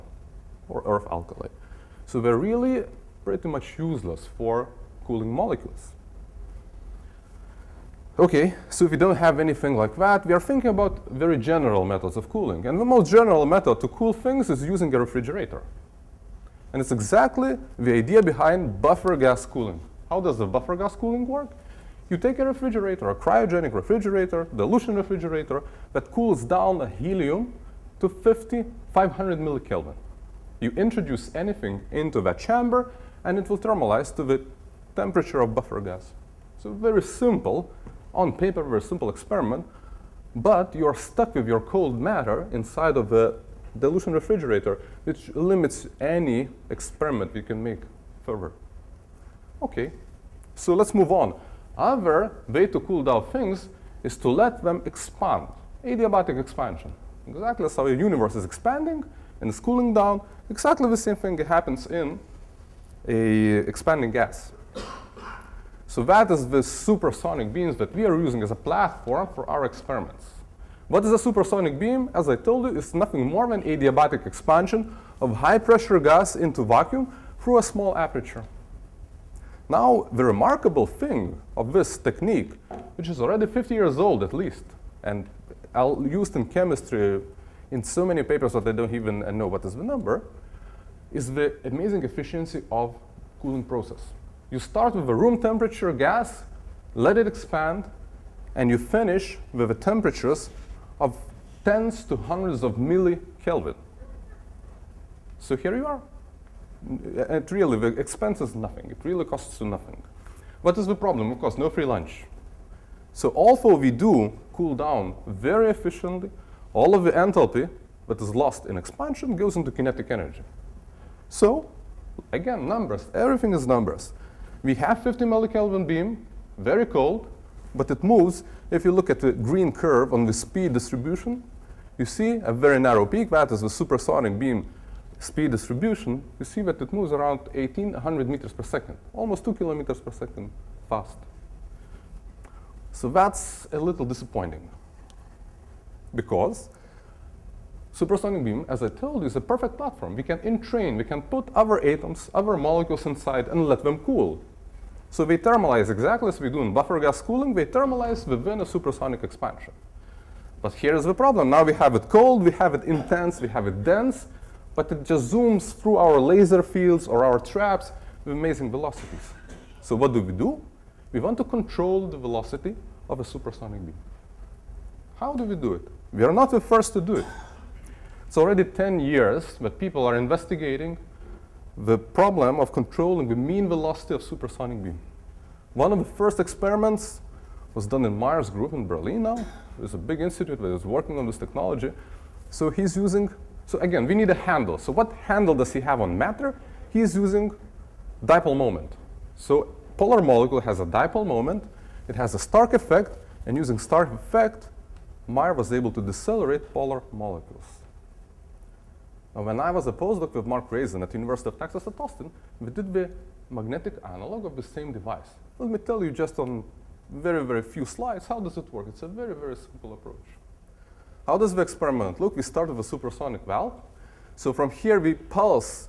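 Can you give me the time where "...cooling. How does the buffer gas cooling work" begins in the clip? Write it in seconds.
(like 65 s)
19 s.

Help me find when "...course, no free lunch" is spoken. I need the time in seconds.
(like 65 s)
111 s.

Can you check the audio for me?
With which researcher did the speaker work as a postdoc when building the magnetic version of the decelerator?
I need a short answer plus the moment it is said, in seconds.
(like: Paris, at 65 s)
Mark Raizen, at 210 s.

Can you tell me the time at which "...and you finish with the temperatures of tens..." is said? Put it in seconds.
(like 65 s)
98 s.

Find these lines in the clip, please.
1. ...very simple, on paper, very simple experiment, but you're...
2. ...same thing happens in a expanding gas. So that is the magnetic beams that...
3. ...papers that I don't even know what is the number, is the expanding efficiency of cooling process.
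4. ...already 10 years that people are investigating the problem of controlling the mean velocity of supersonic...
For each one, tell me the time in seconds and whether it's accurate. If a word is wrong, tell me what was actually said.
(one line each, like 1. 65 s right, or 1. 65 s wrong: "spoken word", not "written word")
1. 36 s right
2. 60 s wrong: "supersonic", not "magnetic"
3. 88 s wrong: "amazing", not "expanding"
4. 178 s right.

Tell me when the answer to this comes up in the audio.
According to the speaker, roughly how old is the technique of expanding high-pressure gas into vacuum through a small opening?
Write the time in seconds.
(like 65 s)
83 s.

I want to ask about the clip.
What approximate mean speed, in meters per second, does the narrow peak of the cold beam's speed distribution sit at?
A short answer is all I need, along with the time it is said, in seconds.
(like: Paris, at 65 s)
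1,800 meters per second, at 137 s.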